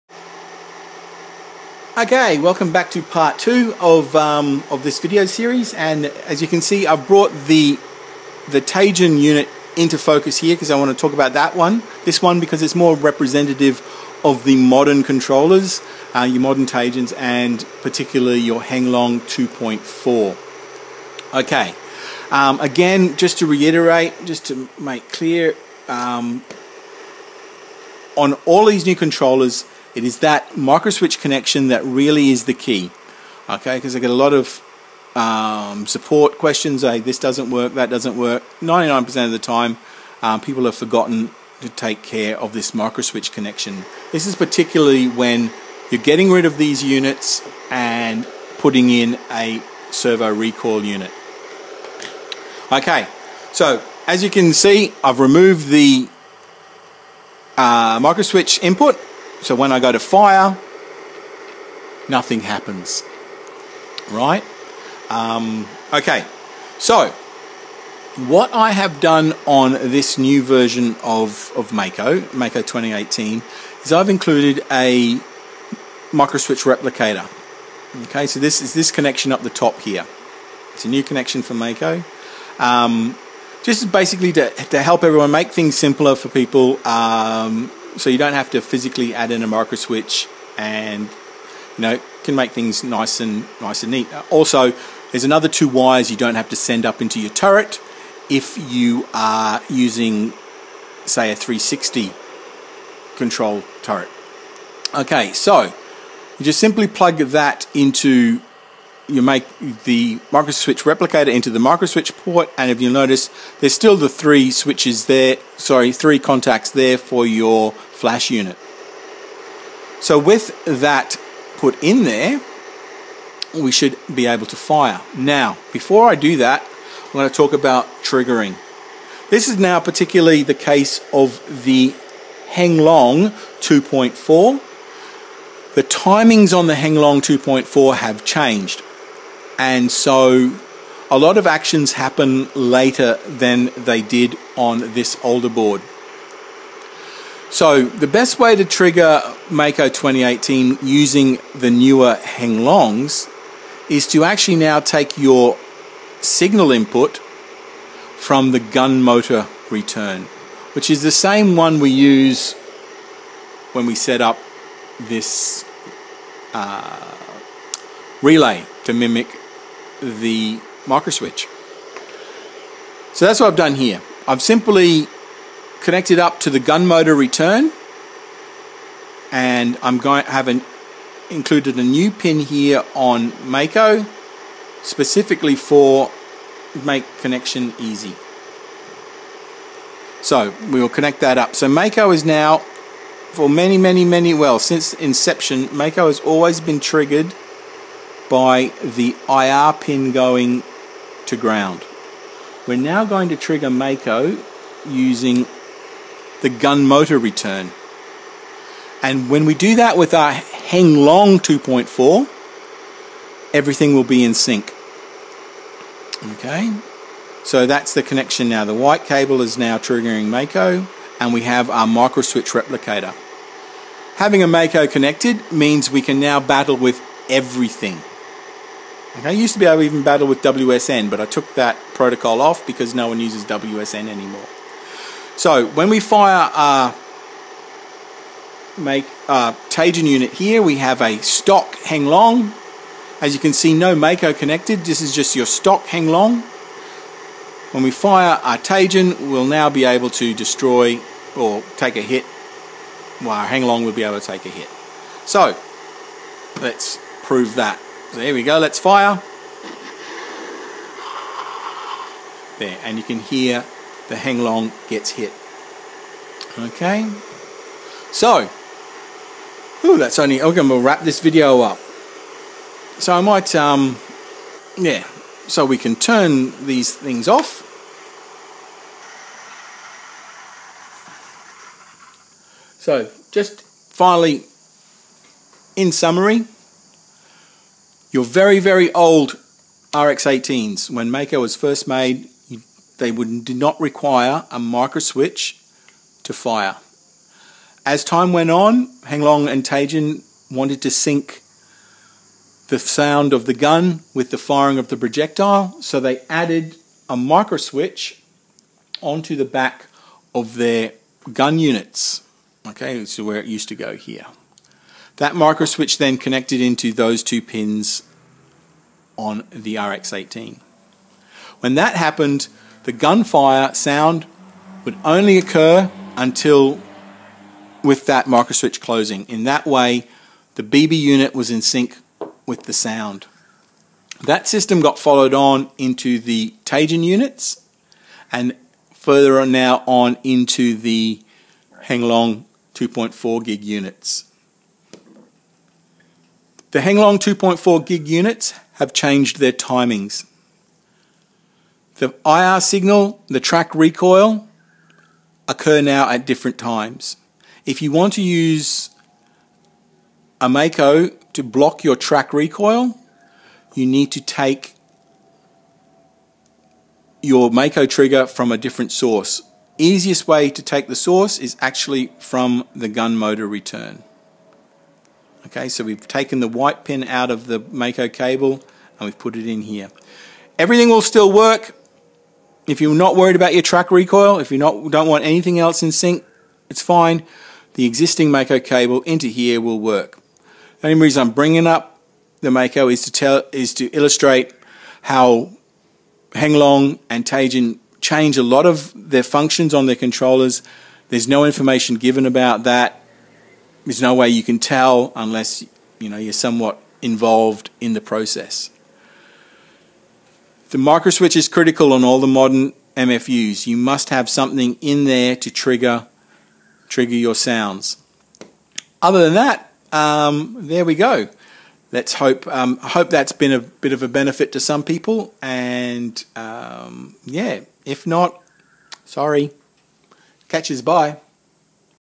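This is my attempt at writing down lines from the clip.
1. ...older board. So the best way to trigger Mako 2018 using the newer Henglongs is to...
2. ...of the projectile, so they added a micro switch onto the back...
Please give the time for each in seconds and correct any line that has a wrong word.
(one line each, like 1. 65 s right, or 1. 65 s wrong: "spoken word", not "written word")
1. 145 s right
2. 304 s right.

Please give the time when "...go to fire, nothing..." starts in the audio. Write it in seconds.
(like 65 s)
59 s.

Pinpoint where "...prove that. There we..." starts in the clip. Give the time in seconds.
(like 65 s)
257 s.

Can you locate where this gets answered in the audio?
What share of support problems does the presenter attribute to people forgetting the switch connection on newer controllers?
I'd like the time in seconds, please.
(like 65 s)
38 s.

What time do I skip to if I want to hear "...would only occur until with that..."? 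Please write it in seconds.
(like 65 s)
324 s.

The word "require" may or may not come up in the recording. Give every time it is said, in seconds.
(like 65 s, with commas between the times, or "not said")
293 s.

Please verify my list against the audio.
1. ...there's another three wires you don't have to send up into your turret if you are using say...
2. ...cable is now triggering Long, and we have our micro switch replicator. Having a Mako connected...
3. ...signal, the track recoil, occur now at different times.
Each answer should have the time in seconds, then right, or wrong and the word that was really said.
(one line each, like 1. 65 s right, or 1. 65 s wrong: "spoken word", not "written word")
1. 95 s wrong: "two", not "three"
2. 219 s wrong: "Mako", not "Long"
3. 352 s right.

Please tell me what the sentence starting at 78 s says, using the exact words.
Okay, so this is this connection up the top here.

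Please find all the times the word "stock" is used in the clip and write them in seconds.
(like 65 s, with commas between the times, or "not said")
241 s, 245 s.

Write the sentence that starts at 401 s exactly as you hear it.
There's no information given about that there's no way you can tell unless you know you're somewhat involved in the process.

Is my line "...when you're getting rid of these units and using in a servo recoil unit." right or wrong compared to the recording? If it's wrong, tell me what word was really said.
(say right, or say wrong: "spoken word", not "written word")
wrong: "putting", not "using".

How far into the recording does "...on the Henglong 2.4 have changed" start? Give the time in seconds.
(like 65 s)
136 s.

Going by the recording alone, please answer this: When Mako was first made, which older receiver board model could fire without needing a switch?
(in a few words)
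RX-18.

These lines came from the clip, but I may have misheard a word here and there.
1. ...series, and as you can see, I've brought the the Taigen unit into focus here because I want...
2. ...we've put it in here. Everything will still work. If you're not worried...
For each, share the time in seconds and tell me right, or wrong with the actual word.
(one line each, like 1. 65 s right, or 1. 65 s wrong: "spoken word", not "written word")
1. 5 s right
2. 379 s right.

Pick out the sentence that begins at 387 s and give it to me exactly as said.
The existing Mako cable into here will work.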